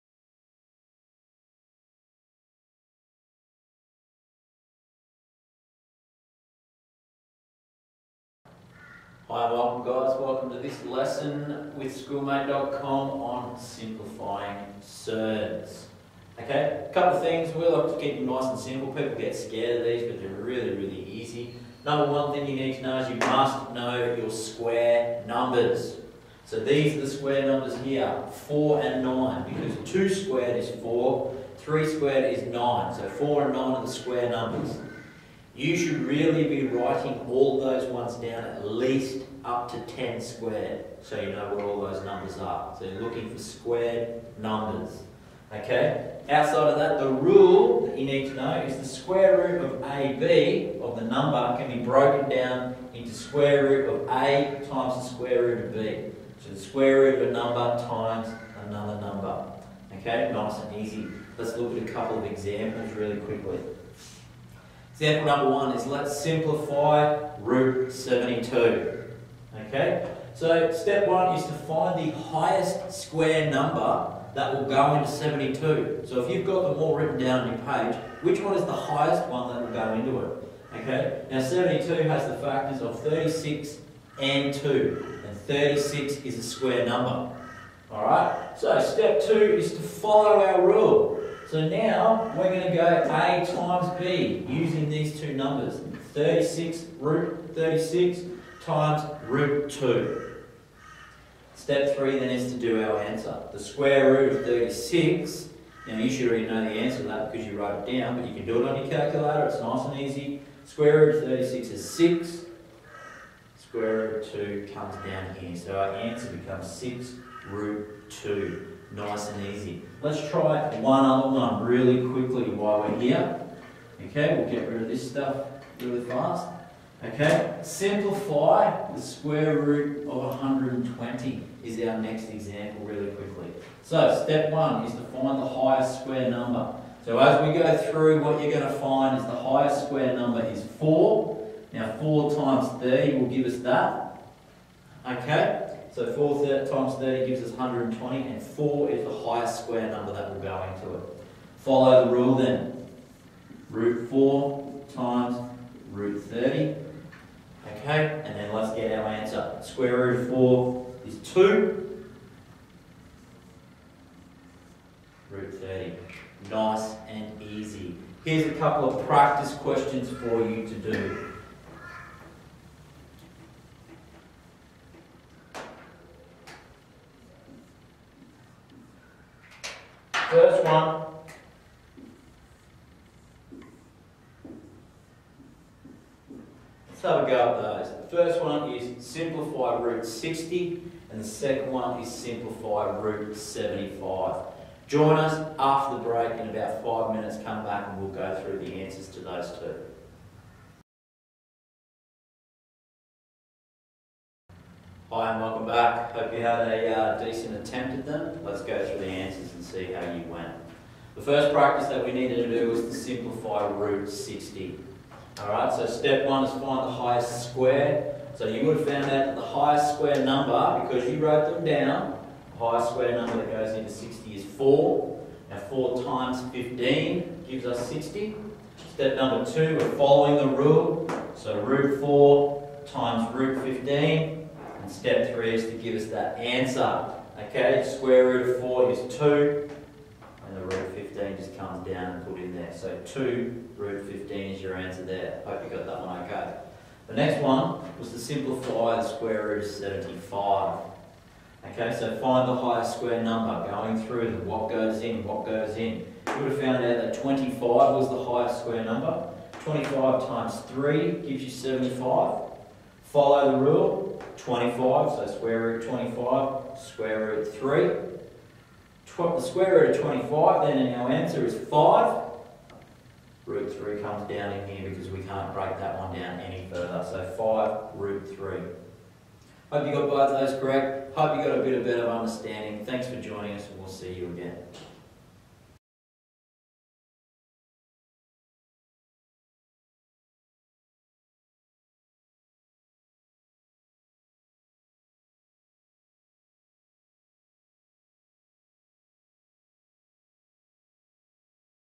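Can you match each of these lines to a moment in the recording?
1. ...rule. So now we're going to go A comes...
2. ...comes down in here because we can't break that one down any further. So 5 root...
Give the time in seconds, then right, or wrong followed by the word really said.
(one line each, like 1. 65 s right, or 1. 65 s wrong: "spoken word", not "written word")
1. 90 s wrong: "times", not "comes"
2. 274 s right.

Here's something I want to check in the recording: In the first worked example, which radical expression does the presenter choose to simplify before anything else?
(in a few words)
root 72.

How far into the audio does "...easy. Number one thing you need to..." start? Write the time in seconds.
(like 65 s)
21 s.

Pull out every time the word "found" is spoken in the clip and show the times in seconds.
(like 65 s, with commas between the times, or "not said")
218 s, 256 s.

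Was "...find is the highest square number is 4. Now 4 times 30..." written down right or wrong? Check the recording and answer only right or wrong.
right.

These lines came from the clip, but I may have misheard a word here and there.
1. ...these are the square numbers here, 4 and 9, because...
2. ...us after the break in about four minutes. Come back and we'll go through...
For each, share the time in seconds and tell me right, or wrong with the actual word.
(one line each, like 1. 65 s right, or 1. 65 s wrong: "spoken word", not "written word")
1. 26 s right
2. 195 s wrong: "five", not "four".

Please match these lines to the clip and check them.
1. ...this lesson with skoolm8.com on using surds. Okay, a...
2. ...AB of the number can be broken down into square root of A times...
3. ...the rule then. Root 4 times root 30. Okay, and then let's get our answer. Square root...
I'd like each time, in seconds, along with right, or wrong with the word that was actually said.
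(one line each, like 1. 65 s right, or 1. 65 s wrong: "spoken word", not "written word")
1. 10 s wrong: "simplifying", not "using"
2. 49 s right
3. 152 s right.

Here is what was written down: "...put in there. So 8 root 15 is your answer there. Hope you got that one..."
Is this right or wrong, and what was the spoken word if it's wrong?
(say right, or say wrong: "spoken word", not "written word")
wrong: "2", not "8".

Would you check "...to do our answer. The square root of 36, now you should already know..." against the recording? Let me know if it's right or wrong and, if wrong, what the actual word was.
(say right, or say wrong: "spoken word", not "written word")
right.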